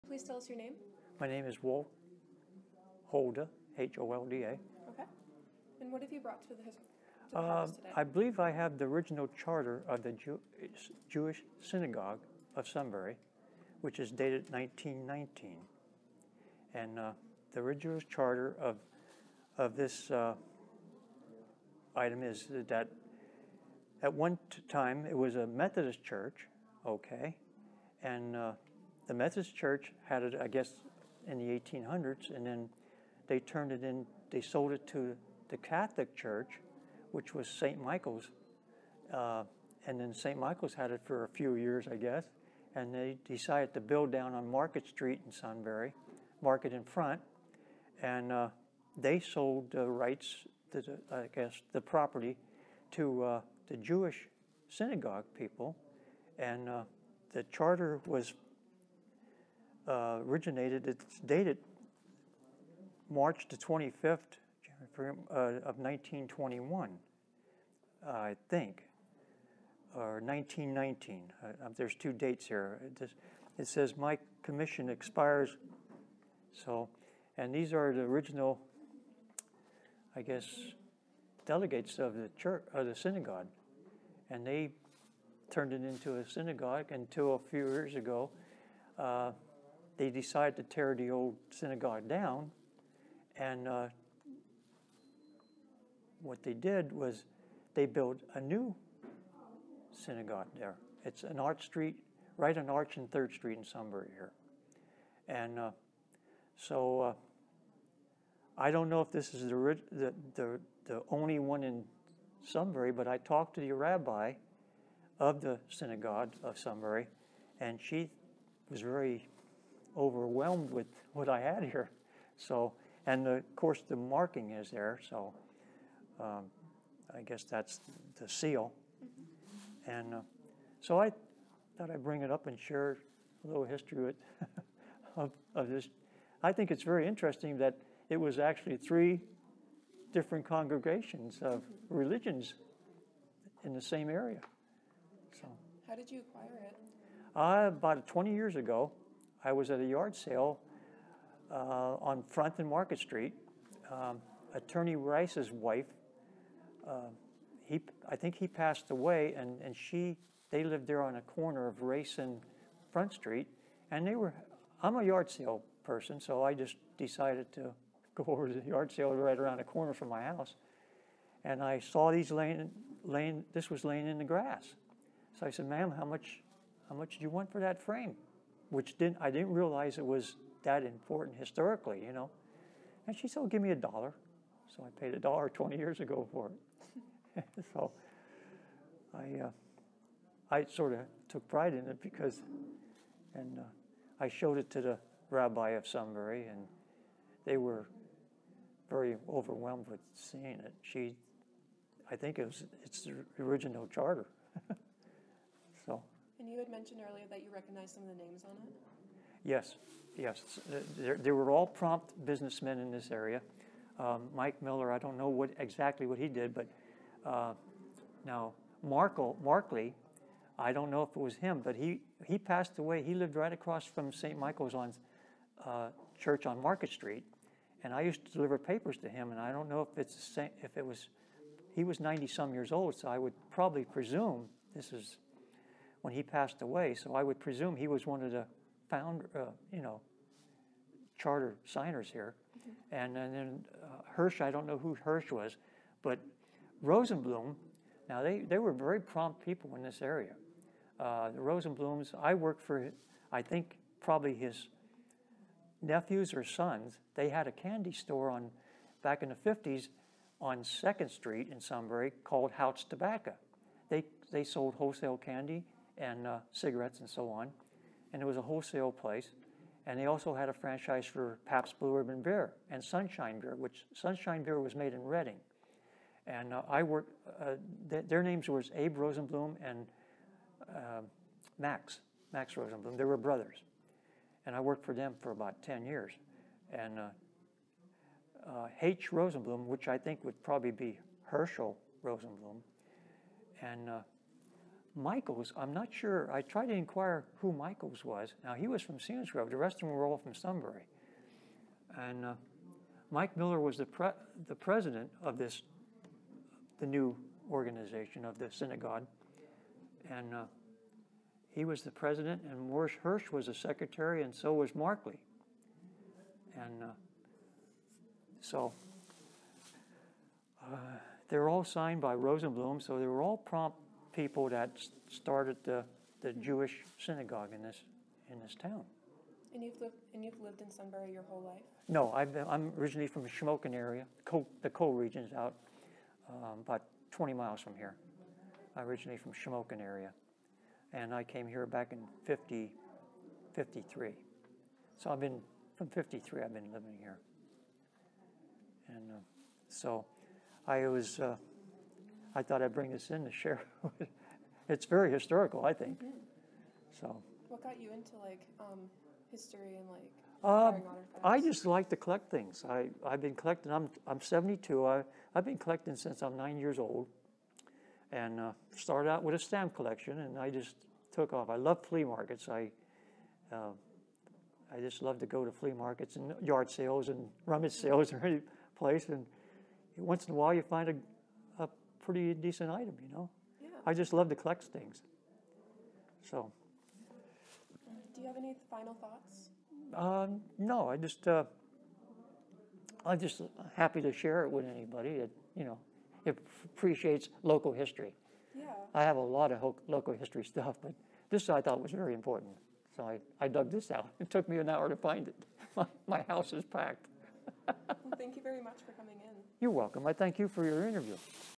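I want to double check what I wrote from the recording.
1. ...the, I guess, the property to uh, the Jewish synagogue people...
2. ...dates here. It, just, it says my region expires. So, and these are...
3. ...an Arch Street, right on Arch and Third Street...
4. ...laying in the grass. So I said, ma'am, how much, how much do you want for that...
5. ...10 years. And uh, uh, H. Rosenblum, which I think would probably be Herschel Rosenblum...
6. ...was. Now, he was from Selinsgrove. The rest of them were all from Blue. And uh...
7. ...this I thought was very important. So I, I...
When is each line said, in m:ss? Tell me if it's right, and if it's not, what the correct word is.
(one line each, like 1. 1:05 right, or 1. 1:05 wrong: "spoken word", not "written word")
1. 0:50 right
2. 1:12 wrong: "commission", not "region"
3. 1:41 right
4. 2:53 right
5. 4:45 right
6. 4:58 wrong: "Sunbury", not "Blue"
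7. 6:41 right.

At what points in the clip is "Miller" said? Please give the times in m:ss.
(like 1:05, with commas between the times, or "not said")
3:34, 5:03.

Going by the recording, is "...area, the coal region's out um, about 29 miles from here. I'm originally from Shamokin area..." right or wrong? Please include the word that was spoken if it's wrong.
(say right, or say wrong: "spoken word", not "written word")
wrong: "20", not "29".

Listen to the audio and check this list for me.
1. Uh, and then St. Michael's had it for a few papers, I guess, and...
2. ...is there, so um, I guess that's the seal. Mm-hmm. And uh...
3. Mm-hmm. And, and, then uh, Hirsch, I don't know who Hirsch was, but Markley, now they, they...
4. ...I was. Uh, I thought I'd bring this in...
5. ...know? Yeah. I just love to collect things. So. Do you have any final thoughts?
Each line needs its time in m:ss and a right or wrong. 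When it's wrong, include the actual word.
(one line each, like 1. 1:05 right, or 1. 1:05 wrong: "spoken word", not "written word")
1. 0:39 wrong: "years", not "papers"
2. 2:04 right
3. 4:02 wrong: "Rosenblum", not "Markley"
4. 5:50 right
5. 6:23 right.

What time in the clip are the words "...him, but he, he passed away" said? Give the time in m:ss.
3:41.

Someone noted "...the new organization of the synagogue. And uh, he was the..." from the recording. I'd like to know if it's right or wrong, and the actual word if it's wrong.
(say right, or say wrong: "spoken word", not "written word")
right.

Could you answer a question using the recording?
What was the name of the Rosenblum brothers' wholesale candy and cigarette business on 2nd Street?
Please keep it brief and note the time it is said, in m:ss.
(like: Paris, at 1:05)
Hout's Tobacco, at 4:22.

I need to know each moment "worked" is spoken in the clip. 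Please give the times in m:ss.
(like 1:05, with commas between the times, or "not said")
4:12, 4:36, 4:44.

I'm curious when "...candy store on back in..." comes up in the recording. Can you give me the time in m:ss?
4:17.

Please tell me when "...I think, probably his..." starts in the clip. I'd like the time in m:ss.
4:13.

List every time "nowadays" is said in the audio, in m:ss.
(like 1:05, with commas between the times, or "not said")
not said.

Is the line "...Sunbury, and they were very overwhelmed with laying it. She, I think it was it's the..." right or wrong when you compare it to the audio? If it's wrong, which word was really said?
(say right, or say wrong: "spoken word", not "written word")
wrong: "seeing", not "laying".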